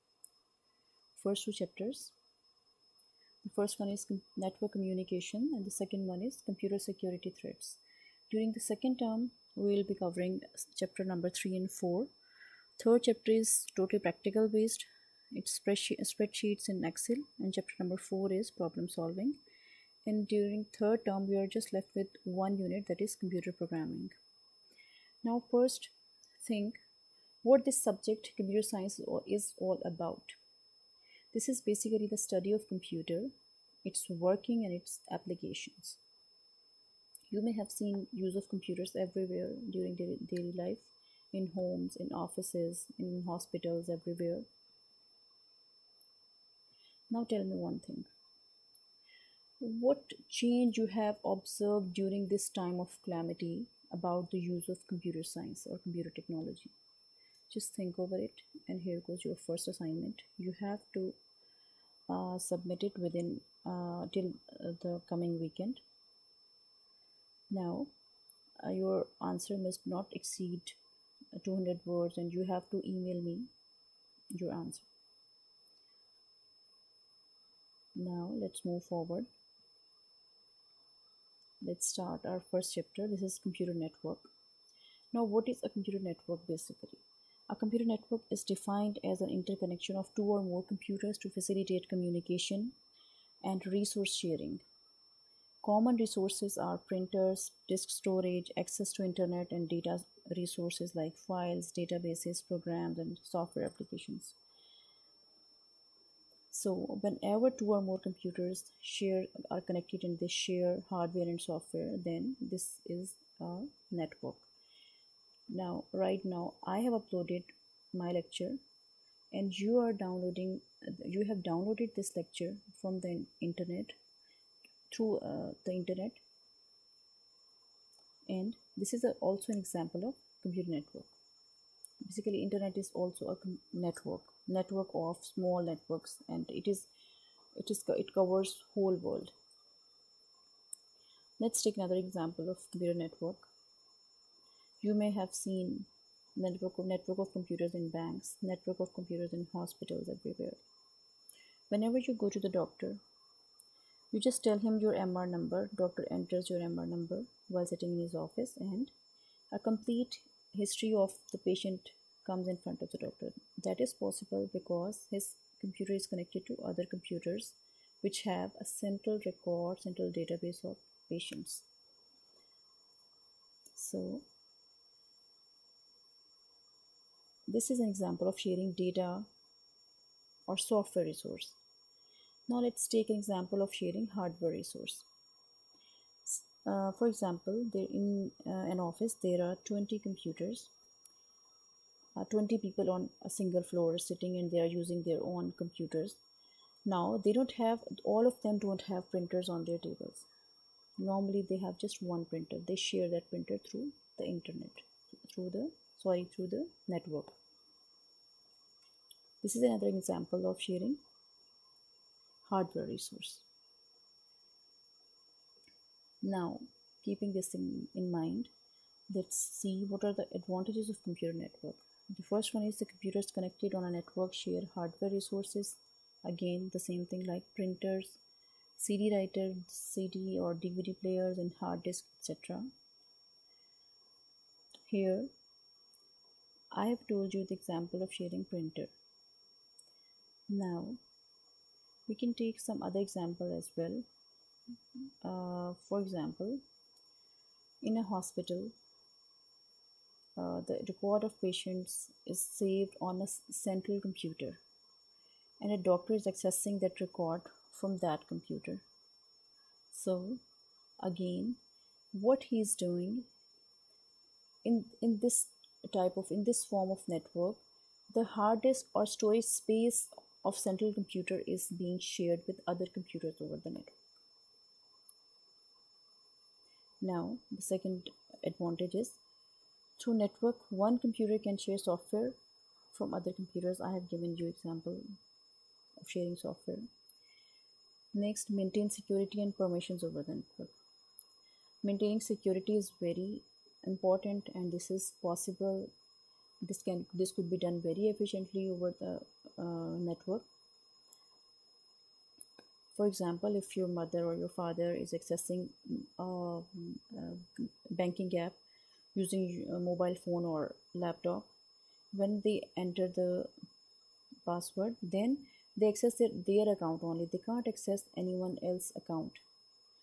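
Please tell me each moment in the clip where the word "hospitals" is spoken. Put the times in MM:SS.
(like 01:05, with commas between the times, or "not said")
00:43, 02:29, 04:08.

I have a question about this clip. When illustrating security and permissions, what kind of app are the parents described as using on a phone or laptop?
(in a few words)
Banking app.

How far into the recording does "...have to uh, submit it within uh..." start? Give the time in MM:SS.
01:00.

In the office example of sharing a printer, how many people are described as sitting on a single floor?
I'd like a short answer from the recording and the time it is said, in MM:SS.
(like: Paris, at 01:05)
20, at 03:12.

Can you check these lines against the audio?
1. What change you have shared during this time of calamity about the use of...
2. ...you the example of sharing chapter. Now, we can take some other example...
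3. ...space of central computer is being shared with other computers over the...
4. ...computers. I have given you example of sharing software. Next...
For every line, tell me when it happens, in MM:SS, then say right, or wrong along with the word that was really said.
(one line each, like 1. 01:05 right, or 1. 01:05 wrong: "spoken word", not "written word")
1. 00:49 wrong: "observed", not "shared"
2. 03:57 wrong: "printer", not "chapter"
3. 04:29 right
4. 04:43 right.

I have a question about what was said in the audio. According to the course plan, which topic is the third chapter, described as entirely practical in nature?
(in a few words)
Spreadsheets in Excel.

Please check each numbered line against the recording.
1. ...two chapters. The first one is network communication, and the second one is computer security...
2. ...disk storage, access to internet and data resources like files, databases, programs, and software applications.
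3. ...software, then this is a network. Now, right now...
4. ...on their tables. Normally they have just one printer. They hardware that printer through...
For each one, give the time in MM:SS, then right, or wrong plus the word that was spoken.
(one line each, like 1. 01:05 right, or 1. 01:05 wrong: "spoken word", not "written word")
1. 00:01 right
2. 01:37 right
3. 01:51 right
4. 03:19 wrong: "share", not "hardware".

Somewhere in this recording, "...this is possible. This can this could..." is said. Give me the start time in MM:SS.
04:54.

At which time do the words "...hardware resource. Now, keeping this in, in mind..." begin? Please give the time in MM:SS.
03:32.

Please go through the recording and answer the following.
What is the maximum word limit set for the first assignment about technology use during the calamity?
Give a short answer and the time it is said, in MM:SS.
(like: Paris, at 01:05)
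200, at 01:11.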